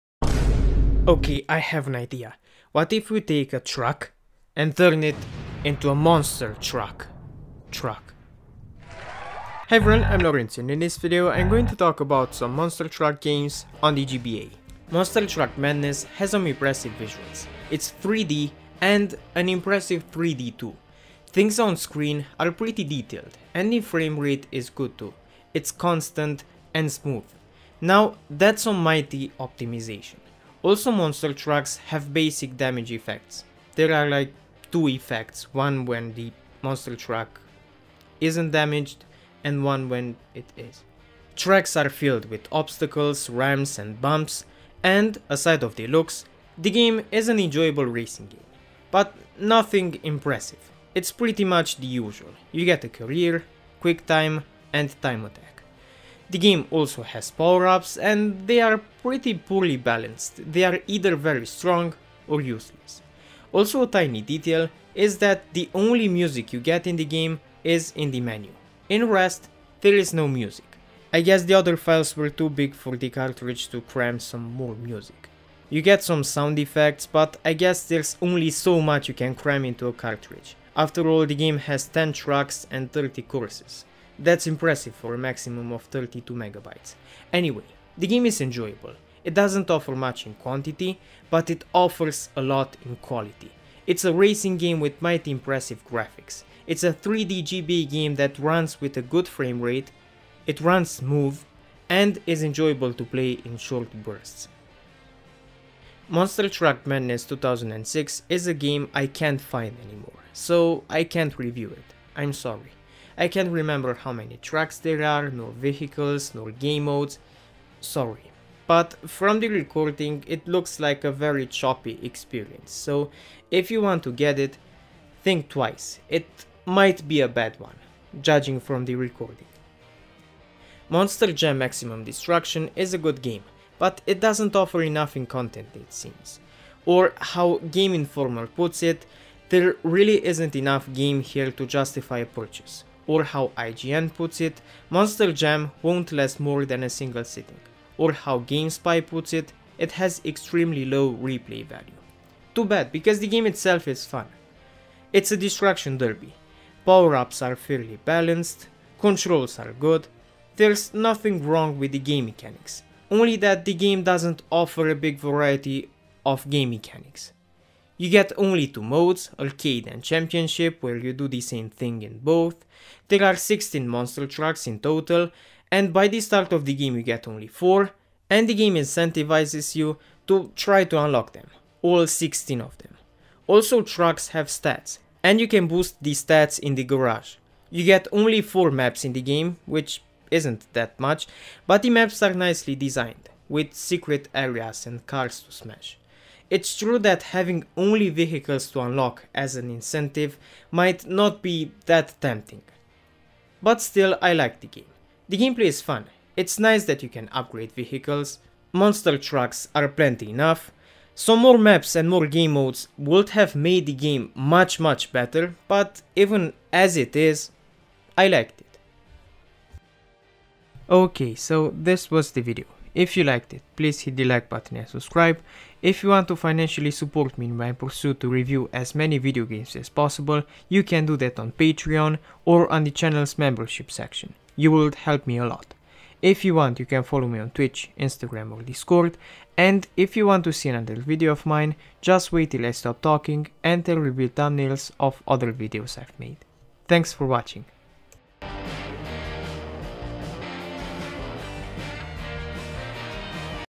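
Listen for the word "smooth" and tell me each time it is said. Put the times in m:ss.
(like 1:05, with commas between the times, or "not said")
0:26, 1:40.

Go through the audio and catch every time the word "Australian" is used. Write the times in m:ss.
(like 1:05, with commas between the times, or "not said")
not said.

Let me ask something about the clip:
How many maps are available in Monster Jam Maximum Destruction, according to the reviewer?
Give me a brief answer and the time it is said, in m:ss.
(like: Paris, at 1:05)
4, at 3:08.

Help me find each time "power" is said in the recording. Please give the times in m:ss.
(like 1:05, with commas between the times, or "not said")
0:57, 2:36.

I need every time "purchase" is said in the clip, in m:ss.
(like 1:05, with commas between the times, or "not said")
2:22.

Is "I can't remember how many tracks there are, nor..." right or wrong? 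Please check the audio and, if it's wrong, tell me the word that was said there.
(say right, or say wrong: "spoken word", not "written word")
right.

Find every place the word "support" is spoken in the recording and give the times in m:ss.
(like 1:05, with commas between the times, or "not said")
3:46.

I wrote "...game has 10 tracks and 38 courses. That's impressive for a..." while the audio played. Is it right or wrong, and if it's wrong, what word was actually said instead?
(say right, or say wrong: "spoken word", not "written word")
wrong: "30", not "38".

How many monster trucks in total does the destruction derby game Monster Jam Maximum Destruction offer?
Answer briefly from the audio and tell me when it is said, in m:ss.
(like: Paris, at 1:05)
16, at 2:53.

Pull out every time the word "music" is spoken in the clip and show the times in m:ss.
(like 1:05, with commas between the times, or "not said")
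1:06, 1:10, 1:14.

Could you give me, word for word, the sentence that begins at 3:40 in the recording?
Okay, so this was the video.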